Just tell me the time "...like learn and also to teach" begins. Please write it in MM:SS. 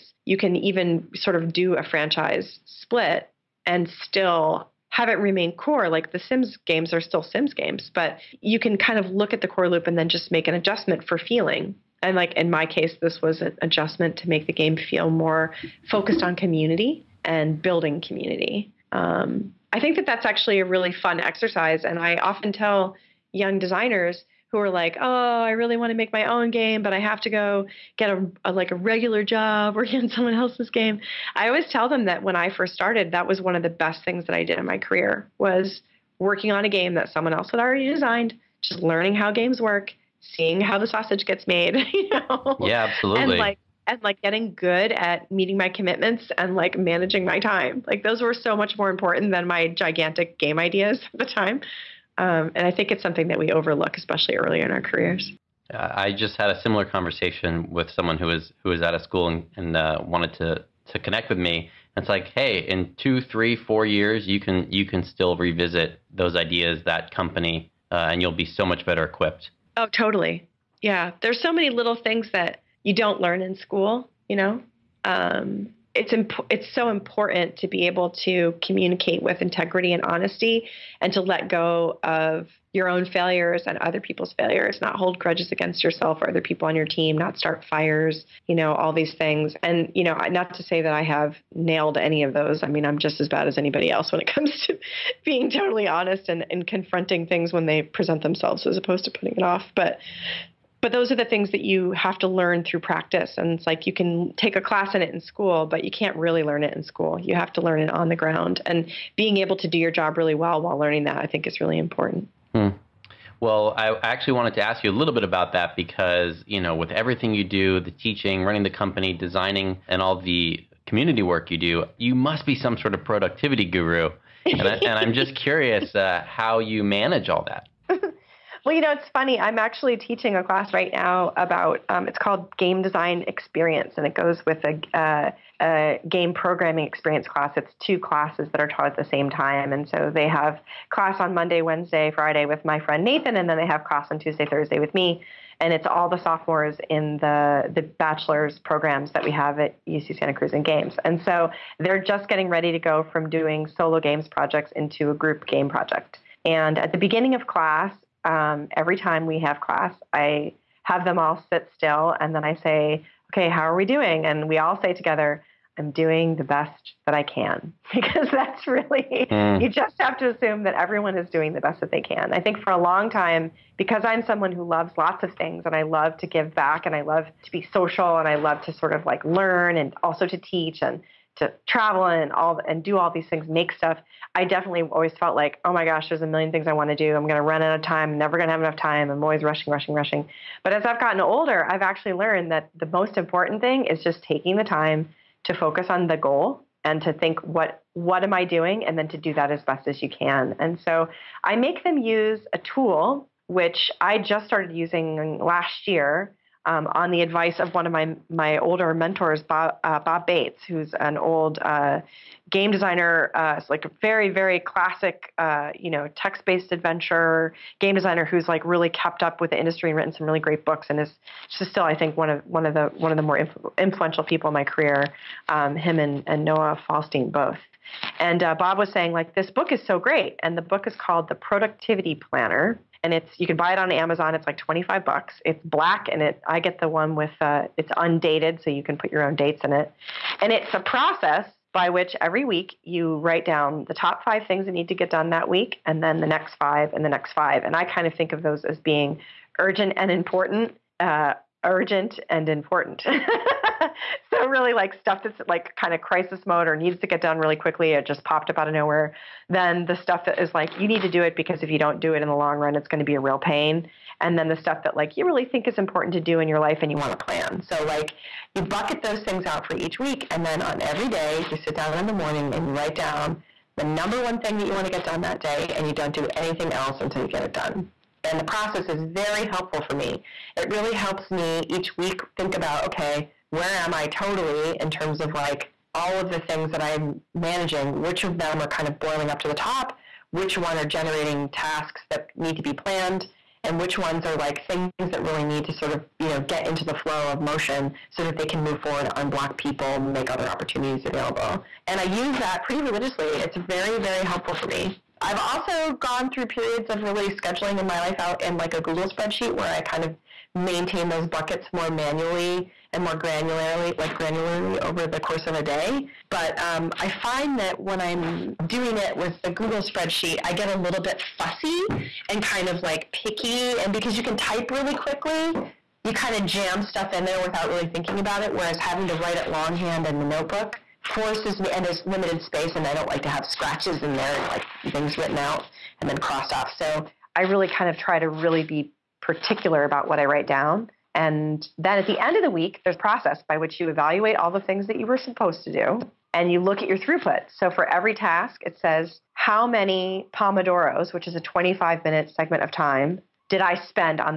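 02:59.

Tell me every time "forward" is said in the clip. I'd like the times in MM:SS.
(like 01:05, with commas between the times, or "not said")
04:58.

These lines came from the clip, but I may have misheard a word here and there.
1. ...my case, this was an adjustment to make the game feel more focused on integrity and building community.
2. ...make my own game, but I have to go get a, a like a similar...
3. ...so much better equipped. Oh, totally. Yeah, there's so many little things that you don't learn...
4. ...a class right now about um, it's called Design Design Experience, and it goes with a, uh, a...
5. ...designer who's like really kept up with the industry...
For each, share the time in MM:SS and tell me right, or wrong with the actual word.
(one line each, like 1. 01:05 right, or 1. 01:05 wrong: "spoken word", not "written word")
1. 00:12 wrong: "community", not "integrity"
2. 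00:25 wrong: "regular", not "similar"
3. 01:08 right
4. 02:10 wrong: "Game", not "Design"
5. 03:37 right.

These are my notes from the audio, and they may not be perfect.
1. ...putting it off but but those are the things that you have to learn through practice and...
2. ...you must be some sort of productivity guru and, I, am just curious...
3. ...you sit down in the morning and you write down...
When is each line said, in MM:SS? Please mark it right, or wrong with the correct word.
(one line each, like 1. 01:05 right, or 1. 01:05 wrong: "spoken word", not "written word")
1. 01:39 right
2. 02:01 right
3. 04:31 right.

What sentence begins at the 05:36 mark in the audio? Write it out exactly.
So I really kind of try to really be particular about what I write down.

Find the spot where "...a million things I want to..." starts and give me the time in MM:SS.
03:06.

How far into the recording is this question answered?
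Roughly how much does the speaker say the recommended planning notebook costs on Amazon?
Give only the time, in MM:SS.
03:54.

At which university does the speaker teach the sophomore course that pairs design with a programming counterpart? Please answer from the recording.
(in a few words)
UC Santa Cruz.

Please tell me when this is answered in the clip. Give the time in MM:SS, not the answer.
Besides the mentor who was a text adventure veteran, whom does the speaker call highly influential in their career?
03:46.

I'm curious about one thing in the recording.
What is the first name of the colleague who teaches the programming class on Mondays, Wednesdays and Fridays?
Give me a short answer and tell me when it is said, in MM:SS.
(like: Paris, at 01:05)
Nathan, at 02:23.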